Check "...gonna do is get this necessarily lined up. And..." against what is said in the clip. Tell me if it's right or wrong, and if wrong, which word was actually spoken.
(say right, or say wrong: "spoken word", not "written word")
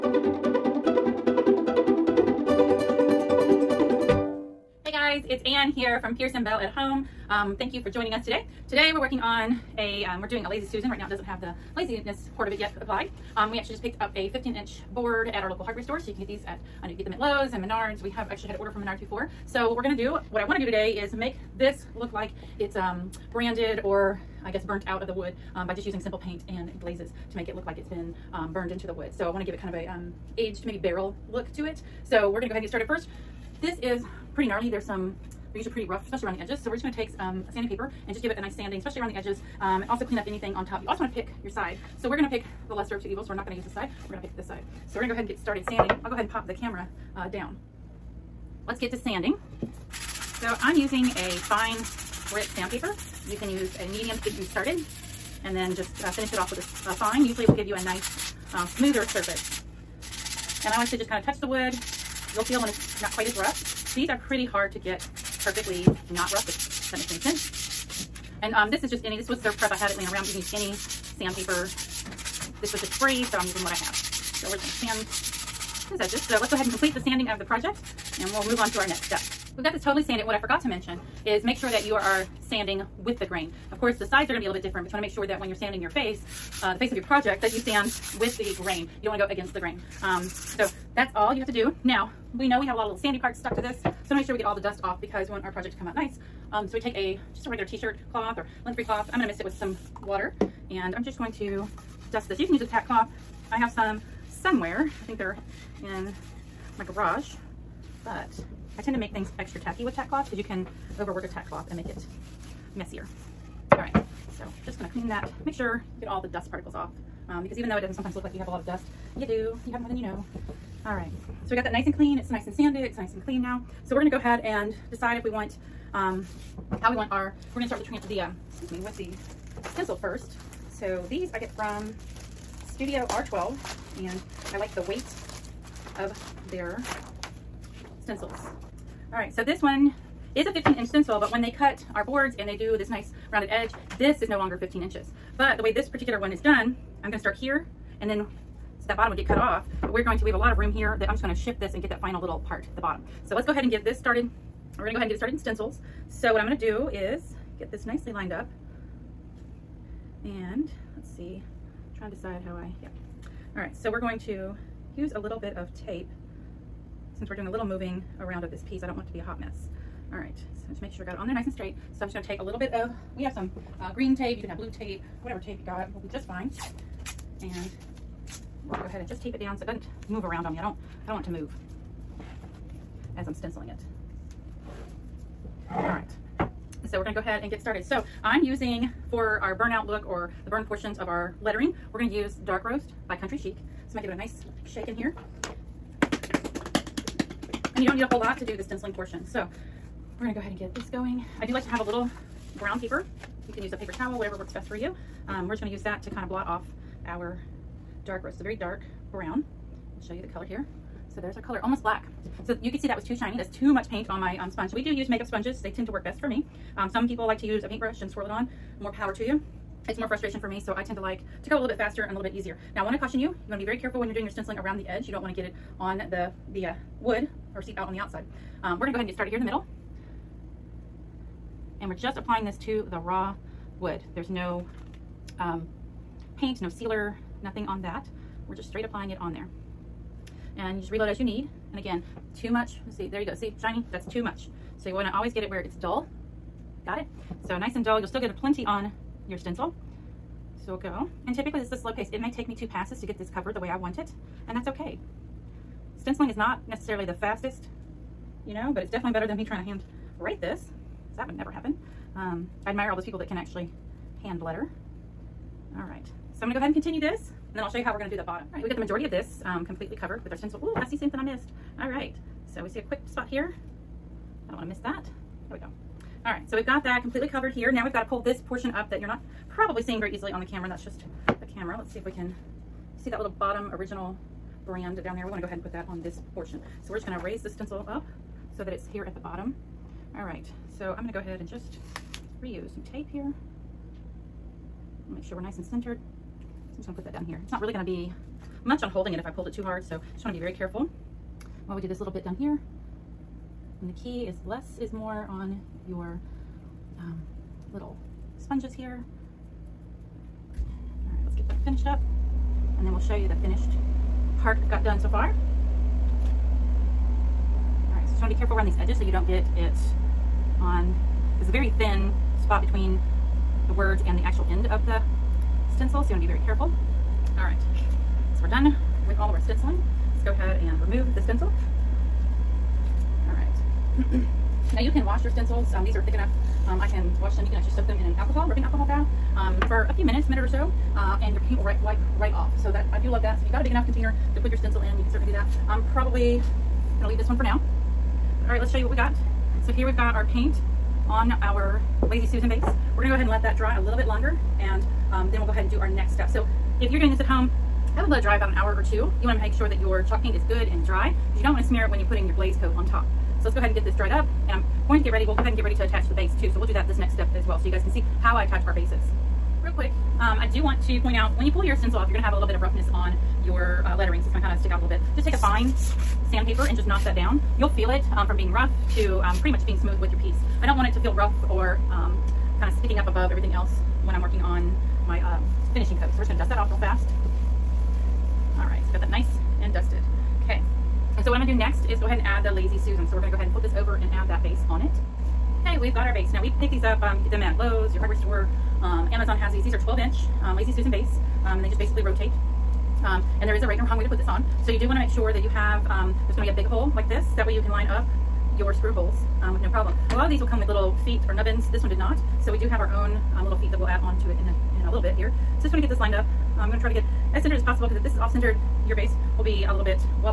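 wrong: "nicely", not "necessarily".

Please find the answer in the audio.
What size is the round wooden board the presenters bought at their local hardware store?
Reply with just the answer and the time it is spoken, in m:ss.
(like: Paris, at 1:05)
15 inch, at 0:14.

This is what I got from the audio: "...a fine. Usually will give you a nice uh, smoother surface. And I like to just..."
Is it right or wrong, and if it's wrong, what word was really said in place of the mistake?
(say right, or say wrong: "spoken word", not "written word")
right.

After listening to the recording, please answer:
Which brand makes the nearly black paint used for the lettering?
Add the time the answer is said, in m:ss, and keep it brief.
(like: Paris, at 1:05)
Country Chic, at 3:13.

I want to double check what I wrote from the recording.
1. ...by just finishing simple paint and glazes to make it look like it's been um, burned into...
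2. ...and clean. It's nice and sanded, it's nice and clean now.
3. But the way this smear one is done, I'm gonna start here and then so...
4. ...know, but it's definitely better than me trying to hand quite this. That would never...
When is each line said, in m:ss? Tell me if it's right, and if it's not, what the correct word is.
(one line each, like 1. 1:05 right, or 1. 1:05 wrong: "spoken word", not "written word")
1. 0:25 wrong: "using", not "finishing"
2. 2:01 right
3. 2:25 wrong: "particular", not "smear"
4. 4:18 wrong: "write", not "quite".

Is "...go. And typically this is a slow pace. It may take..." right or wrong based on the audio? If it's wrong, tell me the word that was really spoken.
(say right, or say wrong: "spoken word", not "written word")
right.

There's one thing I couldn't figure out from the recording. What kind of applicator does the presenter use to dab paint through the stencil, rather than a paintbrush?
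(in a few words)
makeup sponges.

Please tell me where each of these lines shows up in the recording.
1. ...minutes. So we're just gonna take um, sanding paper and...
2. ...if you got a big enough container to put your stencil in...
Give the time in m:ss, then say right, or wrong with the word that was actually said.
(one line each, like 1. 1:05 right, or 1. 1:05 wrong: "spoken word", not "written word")
1. 0:36 wrong: "edges", not "minutes"
2. 5:43 right.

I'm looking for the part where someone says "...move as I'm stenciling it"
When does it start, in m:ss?
3:01.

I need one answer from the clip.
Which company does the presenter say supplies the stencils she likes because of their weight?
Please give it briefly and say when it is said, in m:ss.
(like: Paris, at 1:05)
Studio R12, at 2:12.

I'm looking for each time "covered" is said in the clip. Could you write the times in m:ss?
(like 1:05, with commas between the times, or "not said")
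4:13, 4:29, 4:37.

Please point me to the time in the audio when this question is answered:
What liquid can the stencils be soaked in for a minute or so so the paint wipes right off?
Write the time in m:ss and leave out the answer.
5:38.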